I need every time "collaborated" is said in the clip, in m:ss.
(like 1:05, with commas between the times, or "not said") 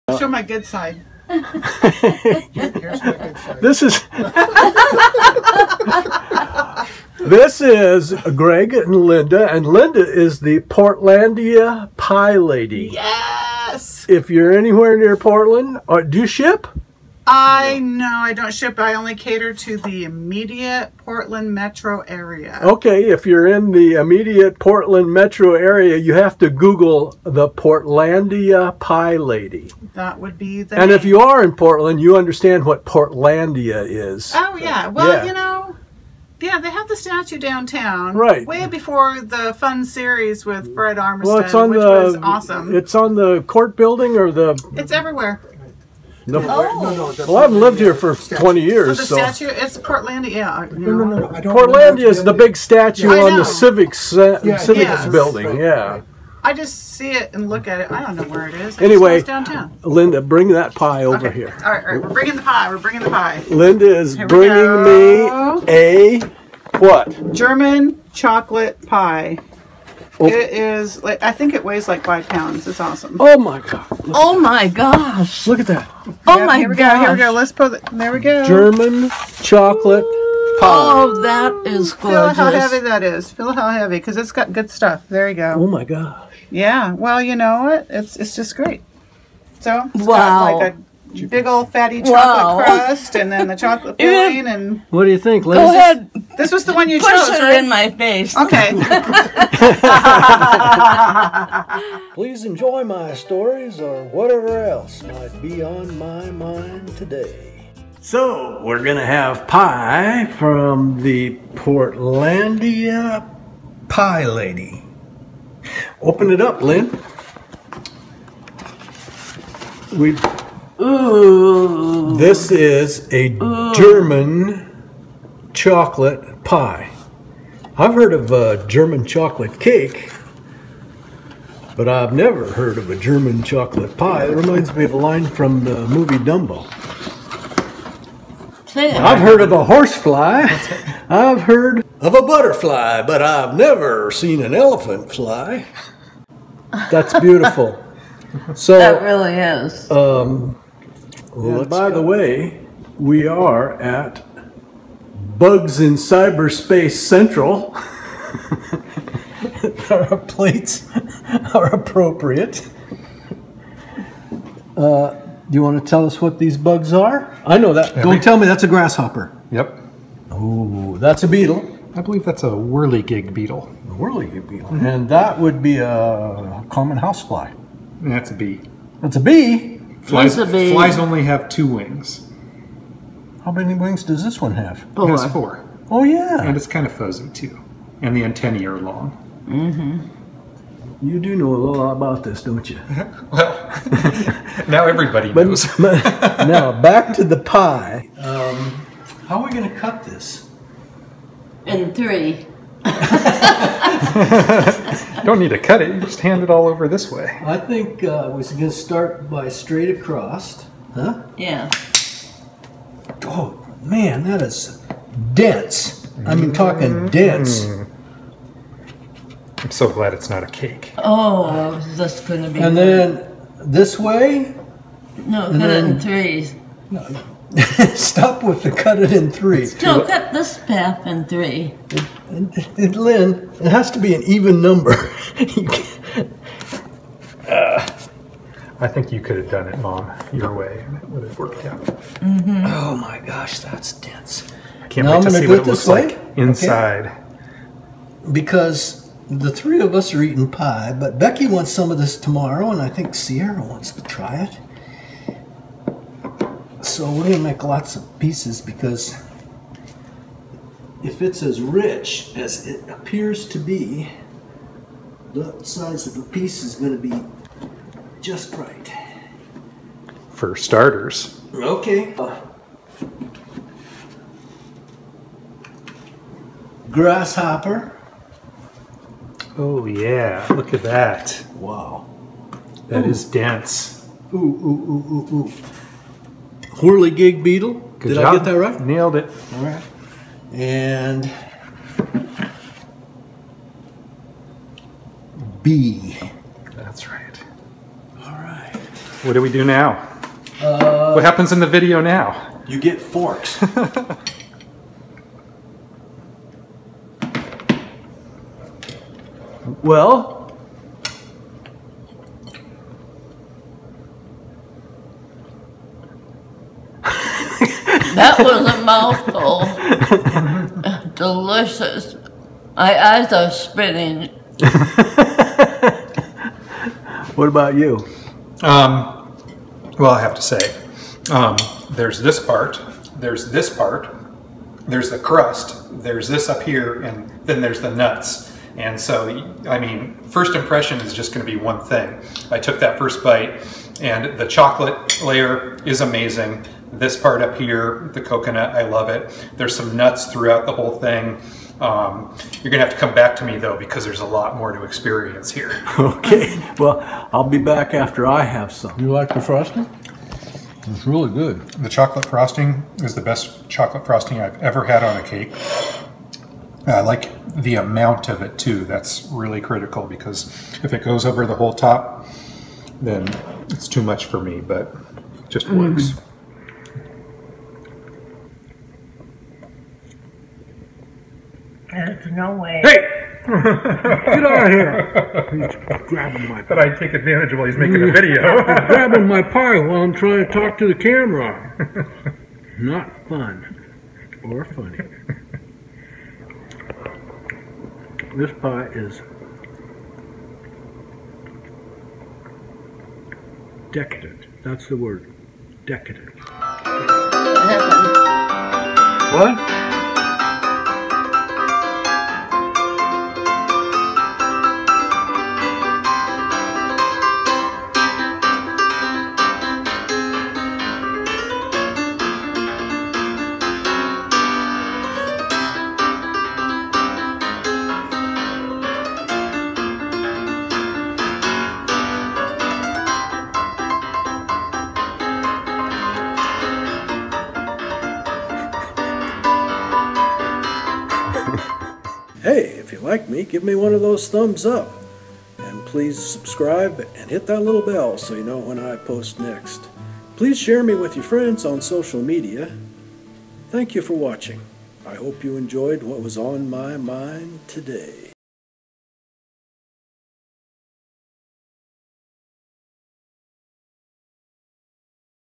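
not said.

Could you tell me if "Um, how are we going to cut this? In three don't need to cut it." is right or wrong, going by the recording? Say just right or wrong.
right.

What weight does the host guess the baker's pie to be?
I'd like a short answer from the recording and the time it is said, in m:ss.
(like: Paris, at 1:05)
five pounds, at 1:12.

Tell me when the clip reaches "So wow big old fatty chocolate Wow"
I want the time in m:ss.
1:29.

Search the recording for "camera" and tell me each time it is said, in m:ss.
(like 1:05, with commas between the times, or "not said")
6:30.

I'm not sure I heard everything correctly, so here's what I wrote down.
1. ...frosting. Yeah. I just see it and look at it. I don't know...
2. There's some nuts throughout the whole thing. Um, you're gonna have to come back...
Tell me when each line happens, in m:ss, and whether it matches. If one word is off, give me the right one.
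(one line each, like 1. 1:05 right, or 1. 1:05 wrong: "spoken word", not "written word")
1. 0:55 wrong: "building", not "frosting"
2. 5:49 right.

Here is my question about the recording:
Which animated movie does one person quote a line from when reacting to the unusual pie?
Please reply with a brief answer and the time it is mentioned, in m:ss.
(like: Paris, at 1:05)
Dumbo, at 2:16.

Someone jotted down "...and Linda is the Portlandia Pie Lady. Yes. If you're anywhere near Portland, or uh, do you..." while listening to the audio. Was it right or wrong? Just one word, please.
right.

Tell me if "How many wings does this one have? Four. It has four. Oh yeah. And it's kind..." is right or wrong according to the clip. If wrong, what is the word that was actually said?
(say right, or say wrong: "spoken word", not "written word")
right.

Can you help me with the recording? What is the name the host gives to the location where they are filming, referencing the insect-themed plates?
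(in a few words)
Bugs in Cyberspace Central.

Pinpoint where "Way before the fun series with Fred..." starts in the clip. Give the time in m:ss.
0:38.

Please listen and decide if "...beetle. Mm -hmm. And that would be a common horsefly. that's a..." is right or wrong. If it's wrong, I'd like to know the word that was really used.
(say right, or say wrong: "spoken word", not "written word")
wrong: "housefly", not "horsefly".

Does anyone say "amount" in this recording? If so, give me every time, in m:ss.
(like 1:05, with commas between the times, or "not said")
6:07.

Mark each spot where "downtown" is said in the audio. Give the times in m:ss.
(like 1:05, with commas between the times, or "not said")
0:37, 0:59.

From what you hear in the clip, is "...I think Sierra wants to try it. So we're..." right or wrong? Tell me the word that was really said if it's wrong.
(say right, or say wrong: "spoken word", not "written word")
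right.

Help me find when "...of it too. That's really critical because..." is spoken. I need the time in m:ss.
6:08.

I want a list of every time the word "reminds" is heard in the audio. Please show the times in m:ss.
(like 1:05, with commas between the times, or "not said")
2:14.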